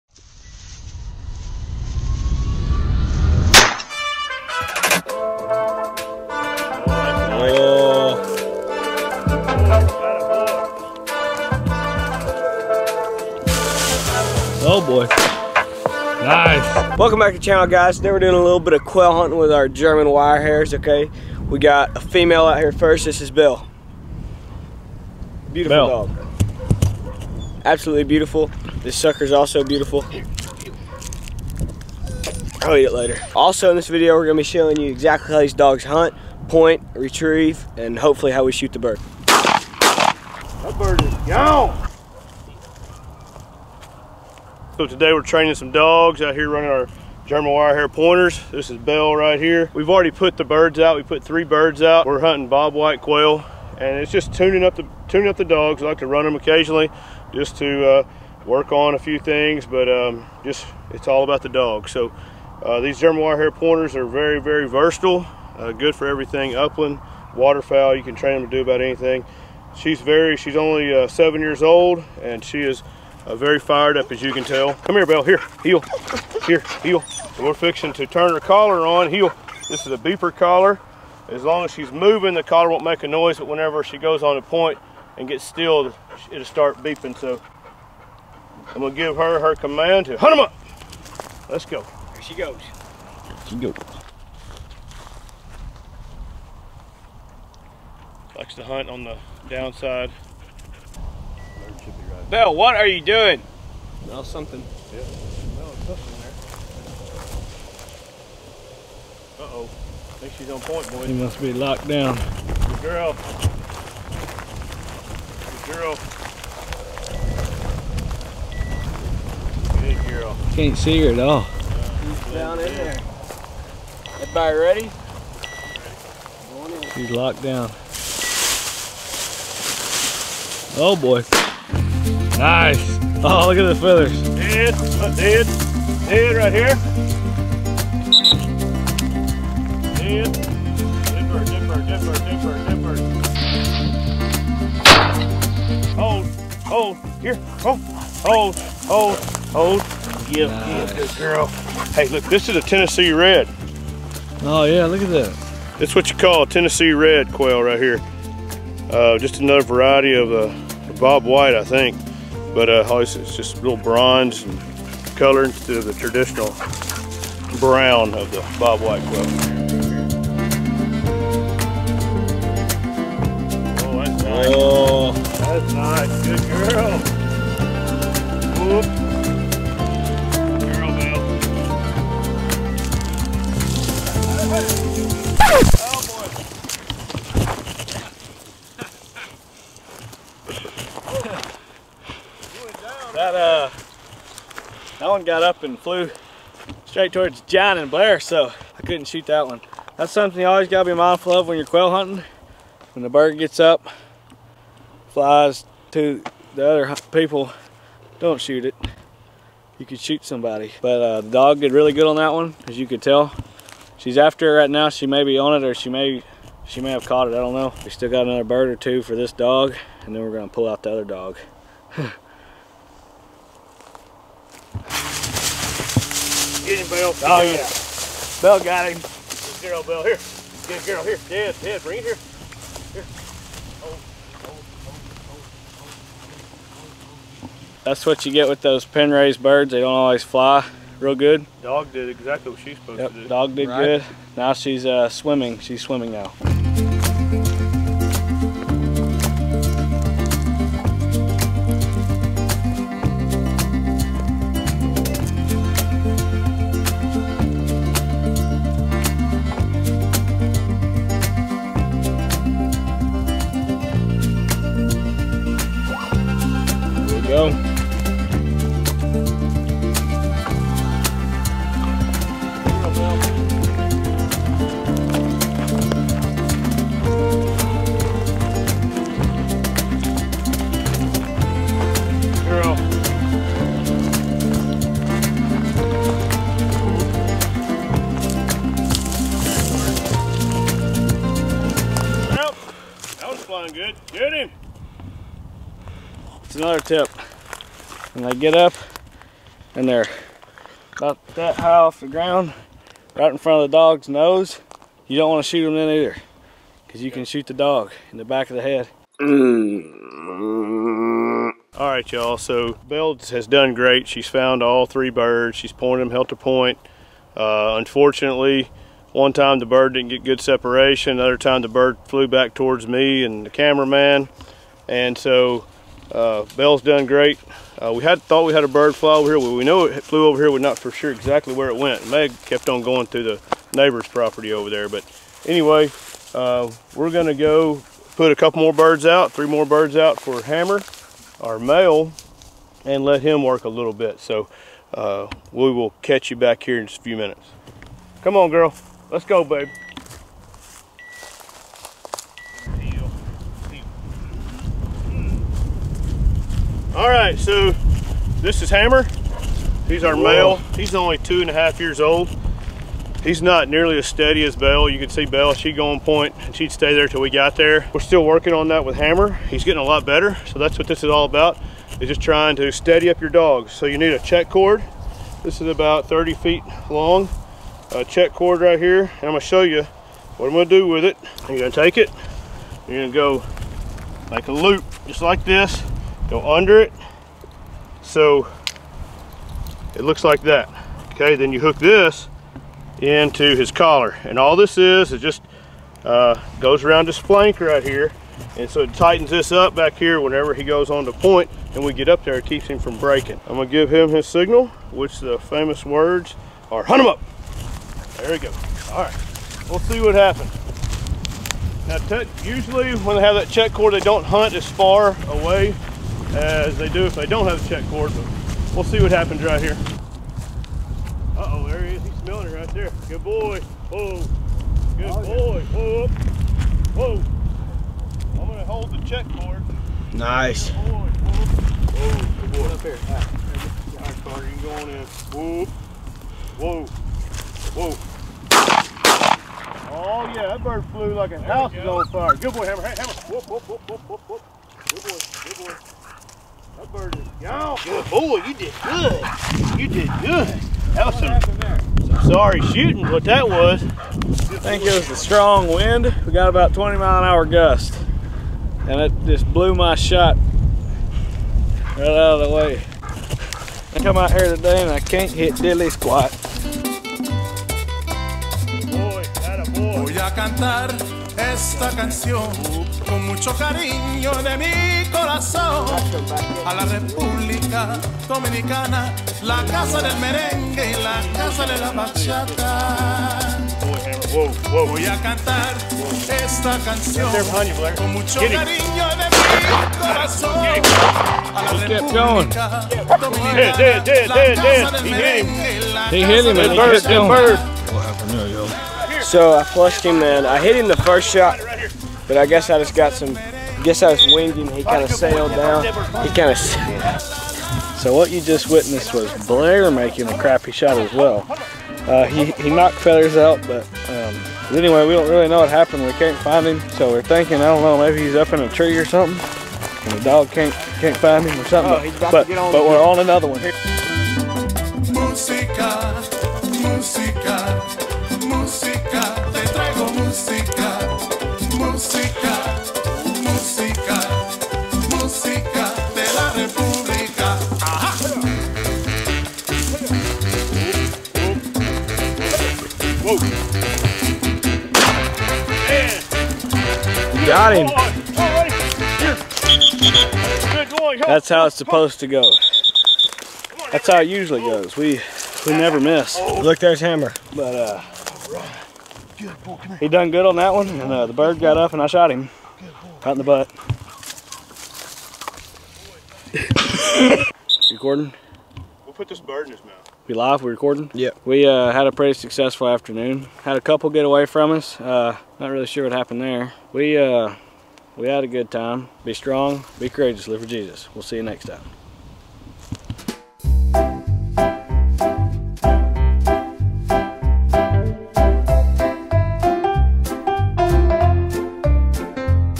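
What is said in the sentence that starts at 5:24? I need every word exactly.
And so uh, bell's done great.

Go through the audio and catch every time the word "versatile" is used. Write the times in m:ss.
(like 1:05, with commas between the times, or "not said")
1:04.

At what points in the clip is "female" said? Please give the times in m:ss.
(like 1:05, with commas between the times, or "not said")
0:22.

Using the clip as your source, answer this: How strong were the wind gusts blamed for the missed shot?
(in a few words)
20 mph.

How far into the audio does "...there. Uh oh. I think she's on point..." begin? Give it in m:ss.
1:49.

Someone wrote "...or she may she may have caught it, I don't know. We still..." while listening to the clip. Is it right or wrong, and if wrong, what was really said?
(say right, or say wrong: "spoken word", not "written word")
right.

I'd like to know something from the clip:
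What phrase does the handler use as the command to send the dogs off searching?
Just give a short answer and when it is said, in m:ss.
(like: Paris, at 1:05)
Hunt him up, at 6:46.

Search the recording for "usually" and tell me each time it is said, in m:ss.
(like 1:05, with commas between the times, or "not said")
6:52, 9:14.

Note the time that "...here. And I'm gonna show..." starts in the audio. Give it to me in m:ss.
6:18.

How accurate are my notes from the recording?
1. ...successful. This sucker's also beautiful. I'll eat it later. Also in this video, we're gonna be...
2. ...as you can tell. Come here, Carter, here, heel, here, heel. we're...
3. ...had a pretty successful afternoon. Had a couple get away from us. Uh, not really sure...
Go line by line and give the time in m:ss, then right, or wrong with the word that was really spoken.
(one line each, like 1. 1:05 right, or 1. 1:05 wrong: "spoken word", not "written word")
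1. 0:28 wrong: "beautiful", not "successful"
2. 1:14 wrong: "Belle", not "Carter"
3. 9:31 right.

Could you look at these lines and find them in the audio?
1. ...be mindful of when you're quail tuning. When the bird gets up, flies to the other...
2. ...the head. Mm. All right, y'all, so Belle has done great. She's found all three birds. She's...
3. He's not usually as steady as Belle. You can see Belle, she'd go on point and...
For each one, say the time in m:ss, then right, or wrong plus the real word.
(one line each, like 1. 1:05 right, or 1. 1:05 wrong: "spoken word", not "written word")
1. 3:20 wrong: "hunting", not "tuning"
2. 5:08 right
3. 6:03 wrong: "nearly", not "usually".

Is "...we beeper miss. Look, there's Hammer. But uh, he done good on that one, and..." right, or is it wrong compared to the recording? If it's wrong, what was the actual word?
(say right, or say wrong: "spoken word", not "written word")
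wrong: "never", not "beeper".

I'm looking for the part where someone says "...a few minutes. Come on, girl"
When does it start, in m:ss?
5:46.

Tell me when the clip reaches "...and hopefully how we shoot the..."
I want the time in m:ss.
0:37.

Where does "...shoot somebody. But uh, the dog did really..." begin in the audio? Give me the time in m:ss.
3:29.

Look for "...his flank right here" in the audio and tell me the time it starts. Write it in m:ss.
6:37.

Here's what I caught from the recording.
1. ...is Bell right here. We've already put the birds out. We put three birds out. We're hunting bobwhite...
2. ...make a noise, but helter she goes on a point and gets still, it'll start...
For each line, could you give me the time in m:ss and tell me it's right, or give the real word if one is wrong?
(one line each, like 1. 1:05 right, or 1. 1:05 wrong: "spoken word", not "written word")
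1. 0:48 right
2. 1:22 wrong: "whenever", not "helter".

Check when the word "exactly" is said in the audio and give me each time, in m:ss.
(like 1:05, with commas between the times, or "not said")
0:34, 4:02, 5:31.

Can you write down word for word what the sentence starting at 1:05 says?
Uh, good for everything upland, waterfowl.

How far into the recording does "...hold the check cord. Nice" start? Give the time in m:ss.
7:08.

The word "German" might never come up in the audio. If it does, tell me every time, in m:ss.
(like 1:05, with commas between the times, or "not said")
0:19, 0:47, 1:02.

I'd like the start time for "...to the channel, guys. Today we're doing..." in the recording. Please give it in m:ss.
0:17.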